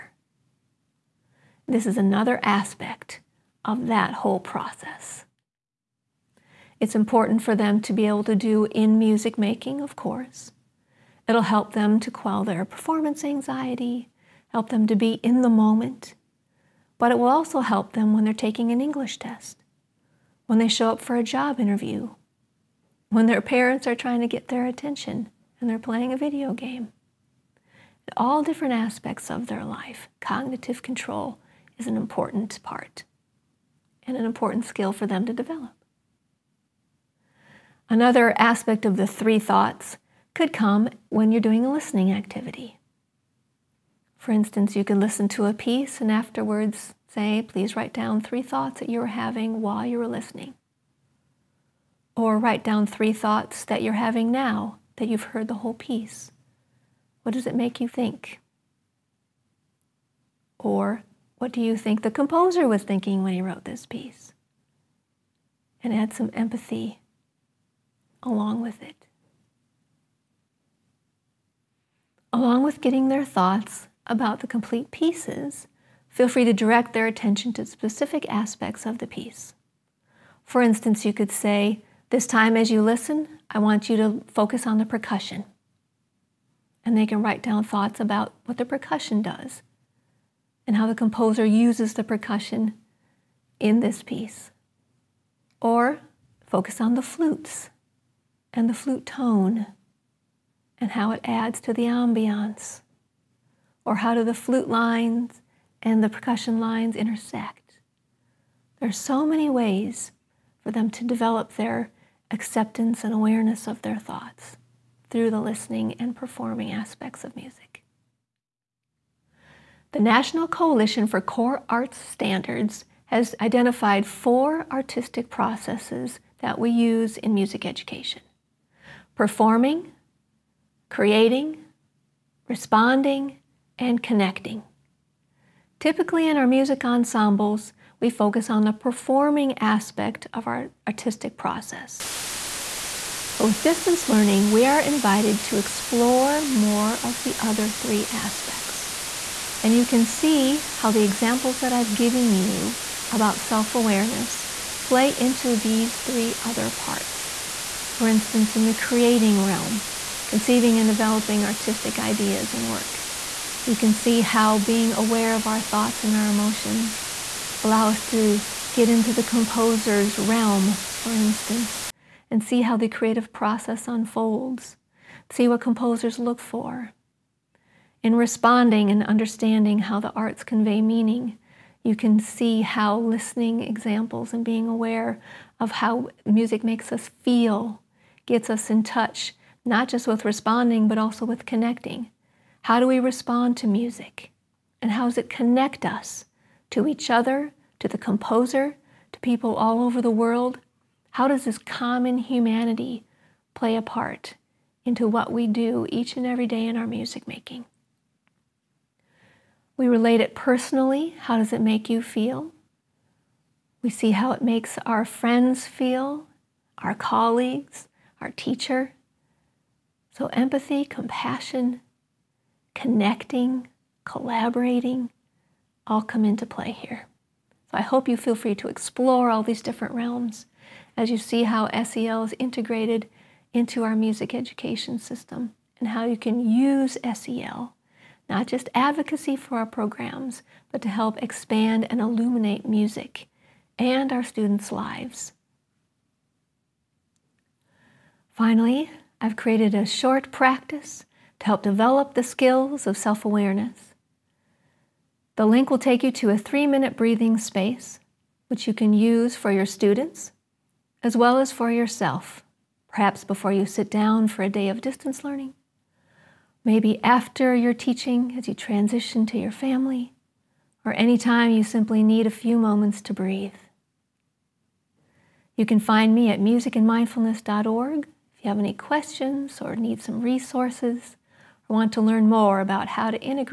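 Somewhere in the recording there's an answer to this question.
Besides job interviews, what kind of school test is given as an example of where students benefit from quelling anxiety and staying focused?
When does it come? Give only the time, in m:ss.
0:18.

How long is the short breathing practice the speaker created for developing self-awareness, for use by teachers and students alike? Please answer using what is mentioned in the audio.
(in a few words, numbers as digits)
3 minutes.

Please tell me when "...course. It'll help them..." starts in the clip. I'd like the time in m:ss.
0:09.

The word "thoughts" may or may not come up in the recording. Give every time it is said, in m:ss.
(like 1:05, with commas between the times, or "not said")
0:39, 0:48, 0:53, 1:13, 1:27, 1:53, 2:45.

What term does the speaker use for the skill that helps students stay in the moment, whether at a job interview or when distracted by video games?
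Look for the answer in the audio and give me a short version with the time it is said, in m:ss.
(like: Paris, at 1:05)
cognitive control, at 0:30.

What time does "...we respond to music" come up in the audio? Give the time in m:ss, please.
3:12.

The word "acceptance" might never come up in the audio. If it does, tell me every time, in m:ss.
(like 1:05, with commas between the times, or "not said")
1:52.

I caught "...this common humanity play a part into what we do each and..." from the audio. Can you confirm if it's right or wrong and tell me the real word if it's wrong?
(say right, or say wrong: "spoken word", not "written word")
right.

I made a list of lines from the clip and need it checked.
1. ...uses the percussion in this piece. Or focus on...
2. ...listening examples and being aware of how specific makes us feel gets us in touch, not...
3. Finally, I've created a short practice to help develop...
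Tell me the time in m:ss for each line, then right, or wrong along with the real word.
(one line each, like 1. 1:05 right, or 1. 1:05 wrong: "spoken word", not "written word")
1. 1:31 right
2. 3:02 wrong: "music", not "specific"
3. 4:08 right.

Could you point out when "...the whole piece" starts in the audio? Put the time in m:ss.
0:55.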